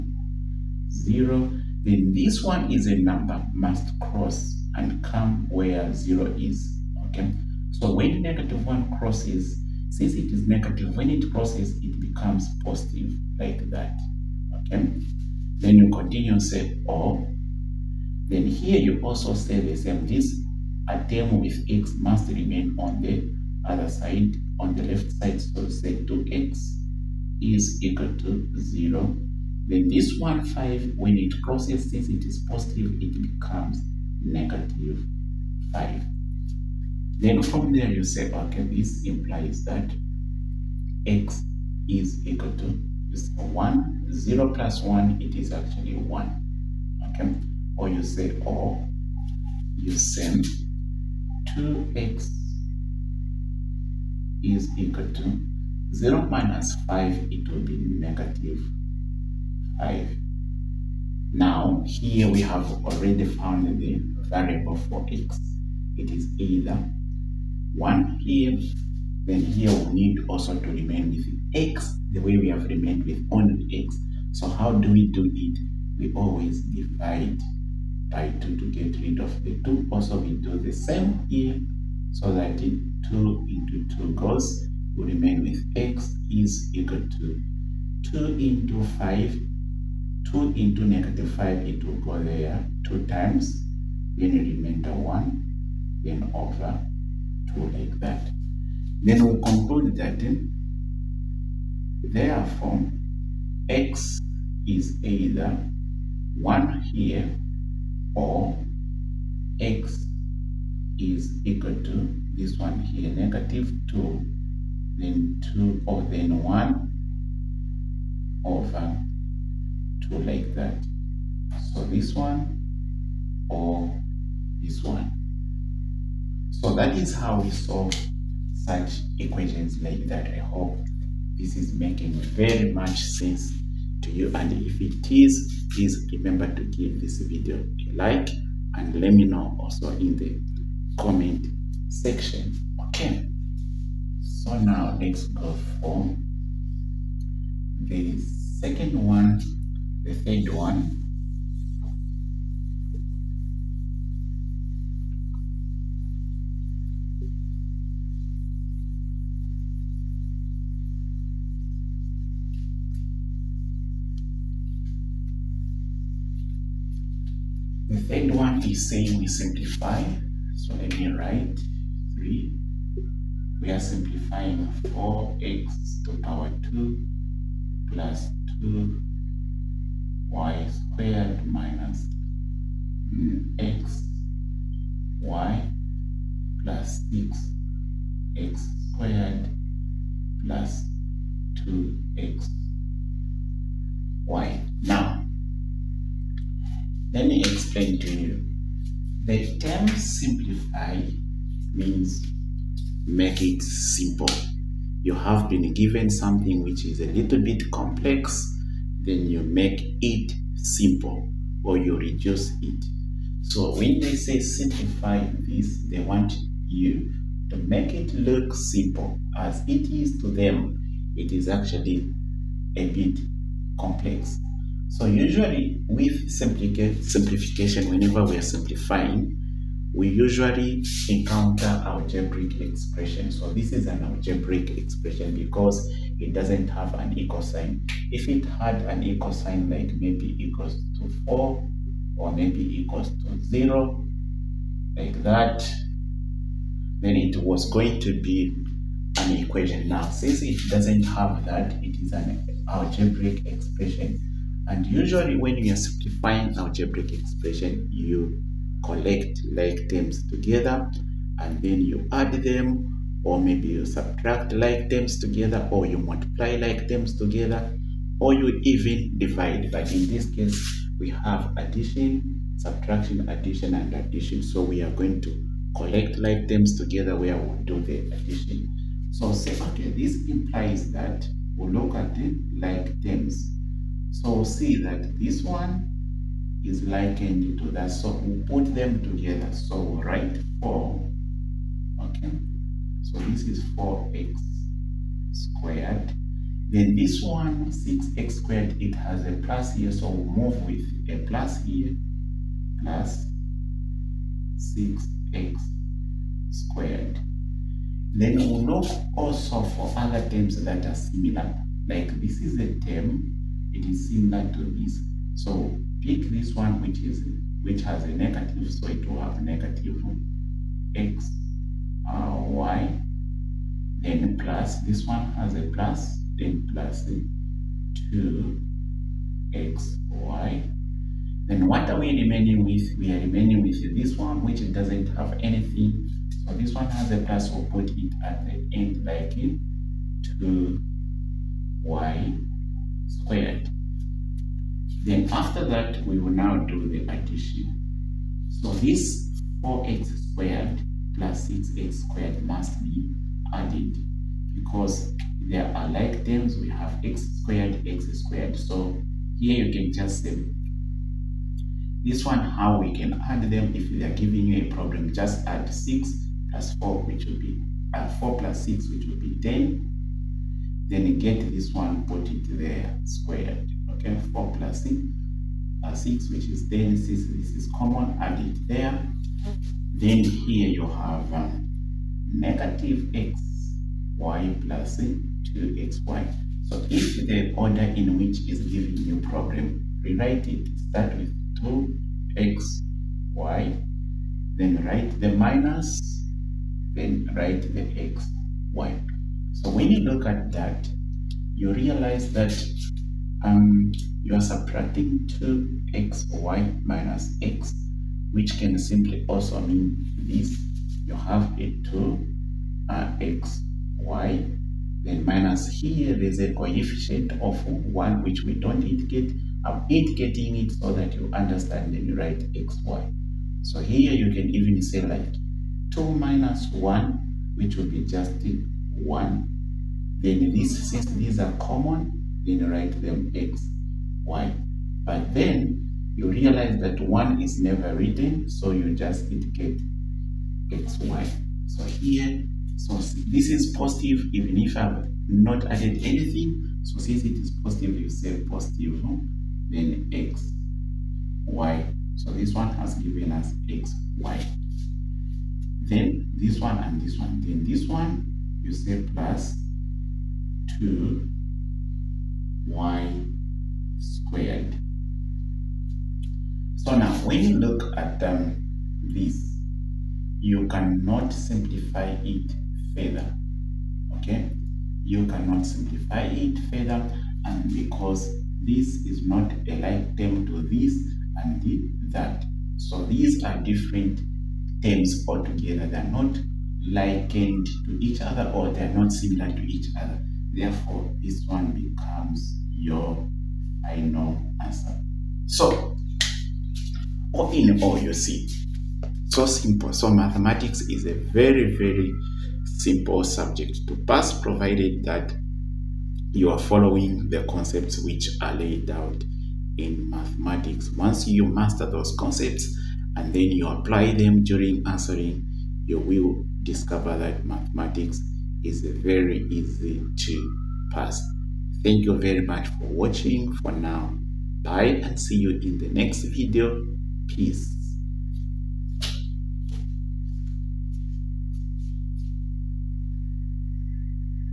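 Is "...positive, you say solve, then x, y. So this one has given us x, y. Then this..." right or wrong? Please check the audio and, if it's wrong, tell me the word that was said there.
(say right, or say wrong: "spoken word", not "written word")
wrong: "positive", not "solve".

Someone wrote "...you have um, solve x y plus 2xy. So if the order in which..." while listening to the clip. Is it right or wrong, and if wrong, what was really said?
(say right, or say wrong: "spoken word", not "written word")
wrong: "negative", not "solve".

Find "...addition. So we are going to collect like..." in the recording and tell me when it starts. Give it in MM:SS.
04:33.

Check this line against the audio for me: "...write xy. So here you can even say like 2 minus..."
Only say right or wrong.
right.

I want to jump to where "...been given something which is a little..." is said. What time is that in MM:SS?
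03:25.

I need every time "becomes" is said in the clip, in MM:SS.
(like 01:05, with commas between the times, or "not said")
00:11, 00:33, 08:11.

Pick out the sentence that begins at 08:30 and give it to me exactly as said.
Once you master those concepts and then you apply them during answering, you will discover that mathematics is very easy to pass.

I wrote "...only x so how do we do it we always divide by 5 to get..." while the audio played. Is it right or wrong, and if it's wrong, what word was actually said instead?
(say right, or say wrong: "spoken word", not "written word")
wrong: "2", not "5".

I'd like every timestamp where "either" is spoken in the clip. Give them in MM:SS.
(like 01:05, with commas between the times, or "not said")
01:06, 01:45.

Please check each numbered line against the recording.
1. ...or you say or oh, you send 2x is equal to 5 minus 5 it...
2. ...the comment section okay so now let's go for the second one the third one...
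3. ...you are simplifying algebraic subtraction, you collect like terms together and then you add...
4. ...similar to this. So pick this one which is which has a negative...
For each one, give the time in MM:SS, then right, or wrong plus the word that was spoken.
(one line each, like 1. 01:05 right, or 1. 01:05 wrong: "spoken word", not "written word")
1. 00:47 wrong: "0", not "5"
2. 02:20 right
3. 04:15 wrong: "expression", not "subtraction"
4. 05:14 right.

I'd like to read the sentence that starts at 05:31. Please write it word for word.
Then what are we remaining with?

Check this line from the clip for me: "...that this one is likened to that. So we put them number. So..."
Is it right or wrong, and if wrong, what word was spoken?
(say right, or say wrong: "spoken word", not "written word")
wrong: "together", not "number".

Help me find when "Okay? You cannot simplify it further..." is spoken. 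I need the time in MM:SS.
07:54.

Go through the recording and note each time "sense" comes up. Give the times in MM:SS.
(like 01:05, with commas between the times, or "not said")
02:13.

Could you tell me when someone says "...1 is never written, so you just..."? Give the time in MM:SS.
07:16.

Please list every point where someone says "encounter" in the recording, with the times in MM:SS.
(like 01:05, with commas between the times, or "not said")
03:51.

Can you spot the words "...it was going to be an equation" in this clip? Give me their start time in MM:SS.
04:07.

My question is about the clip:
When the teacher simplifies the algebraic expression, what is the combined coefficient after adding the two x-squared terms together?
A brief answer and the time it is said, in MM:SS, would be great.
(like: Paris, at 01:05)
10, at 06:08.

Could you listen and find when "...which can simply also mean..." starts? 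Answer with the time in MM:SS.
06:48.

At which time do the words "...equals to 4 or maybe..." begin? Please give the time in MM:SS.
04:00.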